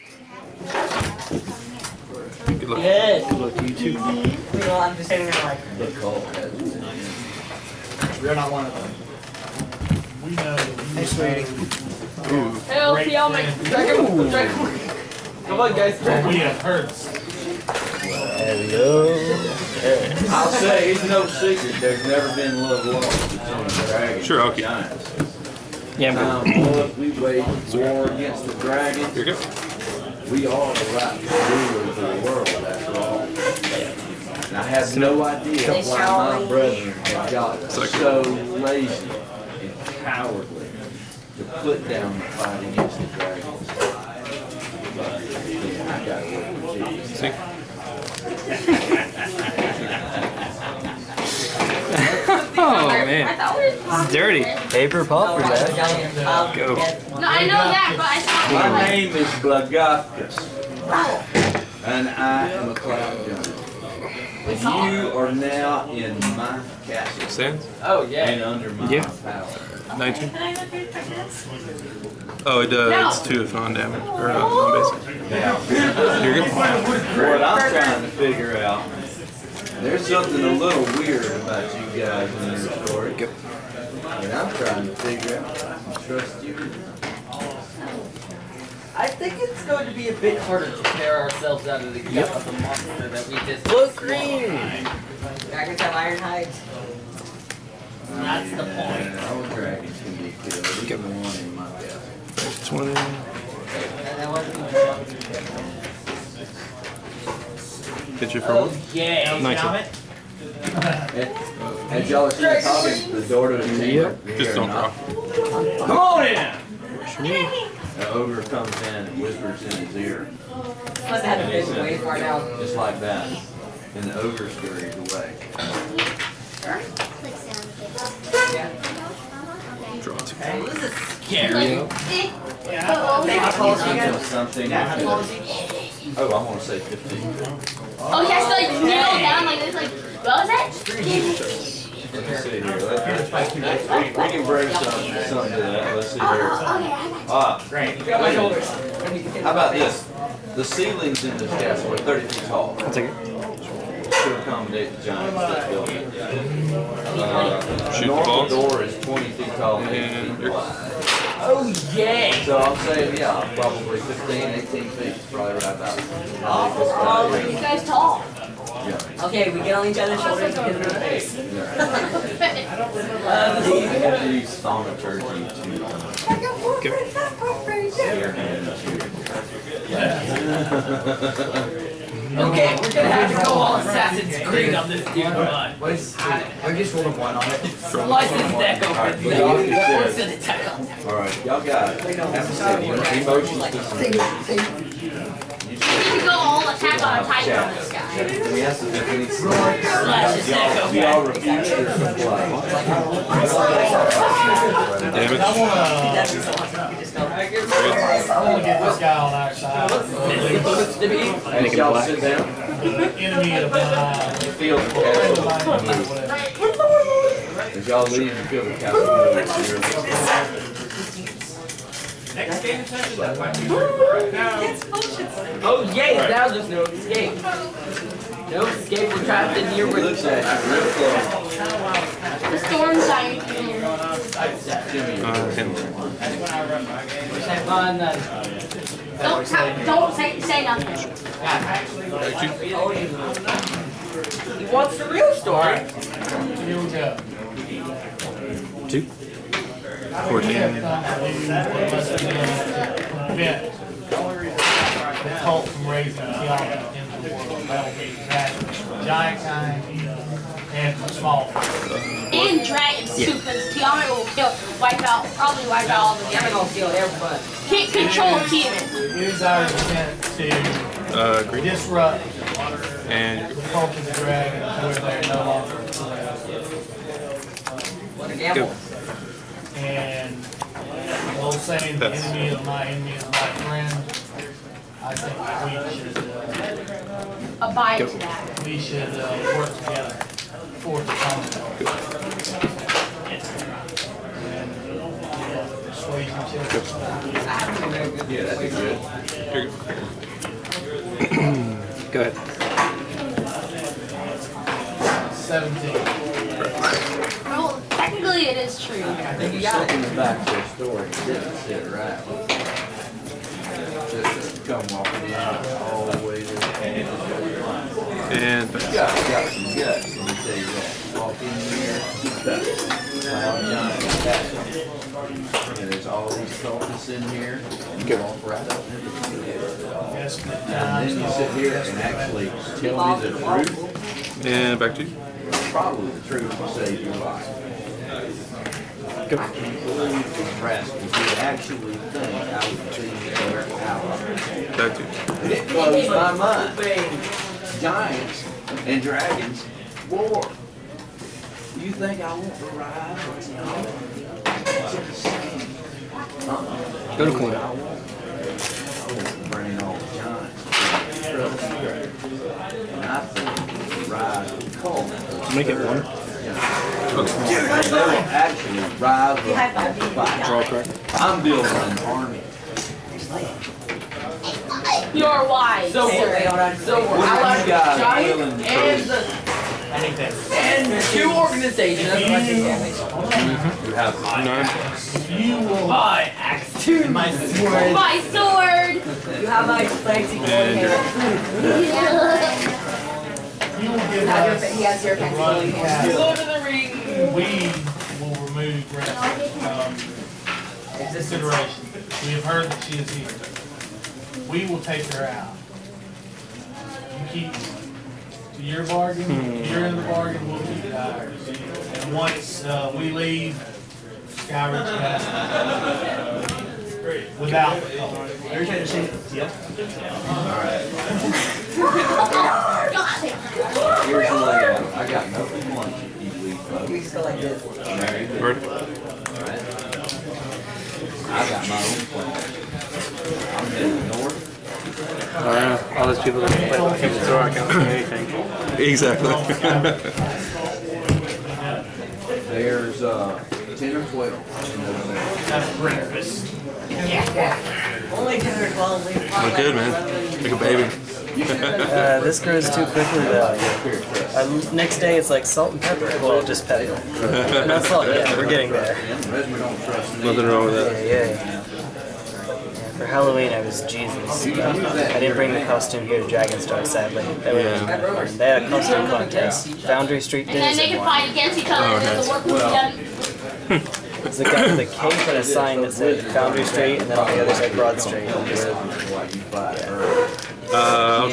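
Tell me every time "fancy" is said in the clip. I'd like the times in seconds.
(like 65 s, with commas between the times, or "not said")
389 s, 395 s.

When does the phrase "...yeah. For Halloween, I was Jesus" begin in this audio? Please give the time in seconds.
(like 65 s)
461 s.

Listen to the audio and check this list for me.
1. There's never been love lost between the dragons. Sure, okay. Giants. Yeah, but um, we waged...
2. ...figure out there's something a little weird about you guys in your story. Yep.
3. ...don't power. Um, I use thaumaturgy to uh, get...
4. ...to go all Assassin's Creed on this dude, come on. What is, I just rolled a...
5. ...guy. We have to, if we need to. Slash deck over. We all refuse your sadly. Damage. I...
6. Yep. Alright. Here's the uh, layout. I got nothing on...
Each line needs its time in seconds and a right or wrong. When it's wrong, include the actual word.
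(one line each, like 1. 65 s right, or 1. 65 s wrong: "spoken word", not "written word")
1. 21 s right
2. 78 s right
3. 172 s wrong: "remember", not "power"
4. 183 s right
5. 197 s wrong: "supply", not "sadly"
6. 419 s right.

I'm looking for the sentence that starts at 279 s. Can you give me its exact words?
And the old saying, the enemy of my enemy is my friend.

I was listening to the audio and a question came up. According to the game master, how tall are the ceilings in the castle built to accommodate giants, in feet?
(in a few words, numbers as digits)
30.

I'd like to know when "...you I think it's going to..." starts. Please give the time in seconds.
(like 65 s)
86 s.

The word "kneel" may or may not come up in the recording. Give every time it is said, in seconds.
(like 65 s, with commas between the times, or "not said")
138 s.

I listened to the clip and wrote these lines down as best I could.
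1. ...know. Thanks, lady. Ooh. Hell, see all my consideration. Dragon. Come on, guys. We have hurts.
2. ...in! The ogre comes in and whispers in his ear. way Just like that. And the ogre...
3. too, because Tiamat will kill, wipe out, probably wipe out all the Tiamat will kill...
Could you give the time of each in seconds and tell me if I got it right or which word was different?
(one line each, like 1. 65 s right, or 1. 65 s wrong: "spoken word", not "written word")
1. 10 s wrong: "dragon", not "consideration"
2. 116 s right
3. 263 s right.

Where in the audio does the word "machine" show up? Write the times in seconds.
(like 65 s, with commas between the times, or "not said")
418 s.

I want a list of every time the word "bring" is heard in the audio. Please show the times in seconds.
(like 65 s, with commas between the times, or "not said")
144 s, 359 s, 465 s.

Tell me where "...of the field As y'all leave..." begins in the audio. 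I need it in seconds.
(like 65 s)
213 s.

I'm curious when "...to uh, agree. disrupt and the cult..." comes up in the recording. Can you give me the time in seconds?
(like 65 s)
270 s.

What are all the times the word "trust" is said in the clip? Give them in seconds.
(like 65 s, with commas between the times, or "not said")
86 s.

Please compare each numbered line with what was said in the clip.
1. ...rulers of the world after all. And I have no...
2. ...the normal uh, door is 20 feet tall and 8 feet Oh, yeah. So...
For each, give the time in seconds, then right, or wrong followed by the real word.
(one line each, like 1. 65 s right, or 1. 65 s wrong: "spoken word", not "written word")
1. 31 s right
2. 158 s right.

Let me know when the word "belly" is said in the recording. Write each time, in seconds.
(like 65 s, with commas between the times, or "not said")
101 s.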